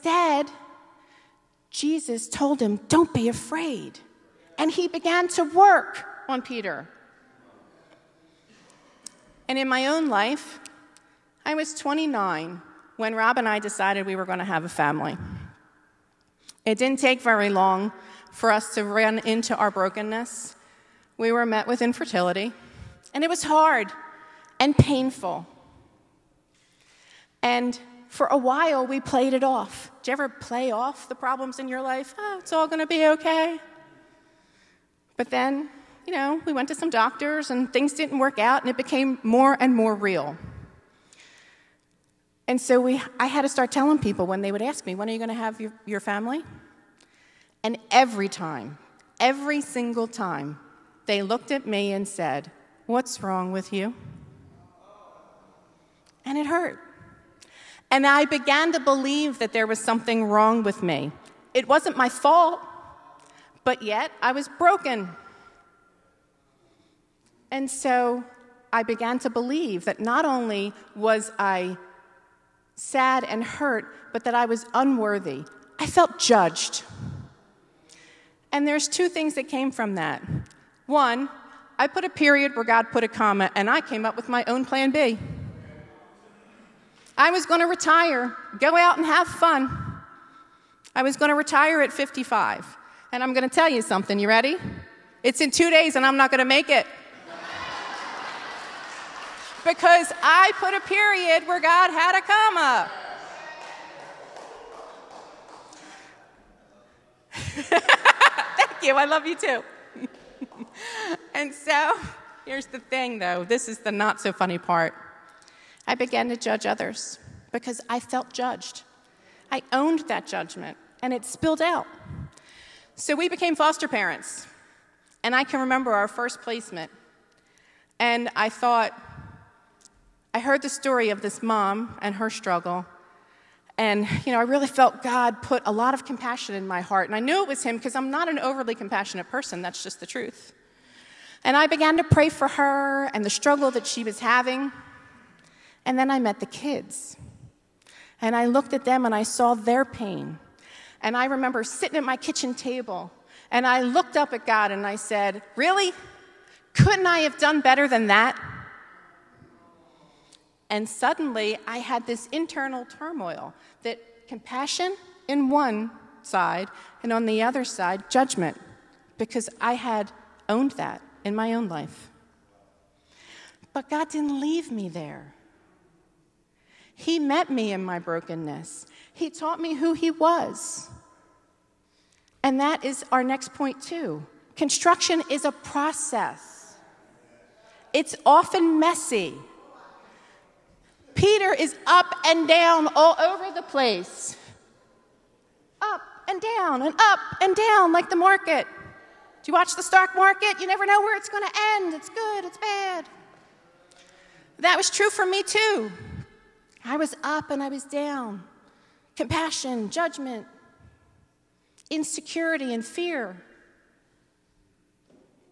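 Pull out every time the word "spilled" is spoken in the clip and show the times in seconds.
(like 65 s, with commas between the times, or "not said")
121 s.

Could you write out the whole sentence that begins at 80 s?
One, I put a period where God put a comma, and I came up with my own plan B.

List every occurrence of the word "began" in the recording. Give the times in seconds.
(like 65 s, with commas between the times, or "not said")
4 s, 58 s, 68 s, 115 s, 141 s.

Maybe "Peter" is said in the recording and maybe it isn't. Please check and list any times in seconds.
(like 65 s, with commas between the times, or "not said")
6 s, 191 s.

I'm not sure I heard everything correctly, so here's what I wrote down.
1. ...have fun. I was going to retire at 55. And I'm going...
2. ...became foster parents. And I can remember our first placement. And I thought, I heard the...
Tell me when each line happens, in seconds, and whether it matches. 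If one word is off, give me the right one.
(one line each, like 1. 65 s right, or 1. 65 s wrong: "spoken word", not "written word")
1. 89 s right
2. 123 s right.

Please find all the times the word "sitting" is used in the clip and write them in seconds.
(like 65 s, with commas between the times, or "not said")
151 s.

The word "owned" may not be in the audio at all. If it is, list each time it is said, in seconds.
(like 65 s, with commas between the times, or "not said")
119 s, 170 s.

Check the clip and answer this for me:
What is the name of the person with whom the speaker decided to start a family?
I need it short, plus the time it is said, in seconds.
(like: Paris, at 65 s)
Rob, at 13 s.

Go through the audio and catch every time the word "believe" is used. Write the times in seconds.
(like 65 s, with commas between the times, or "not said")
58 s, 69 s.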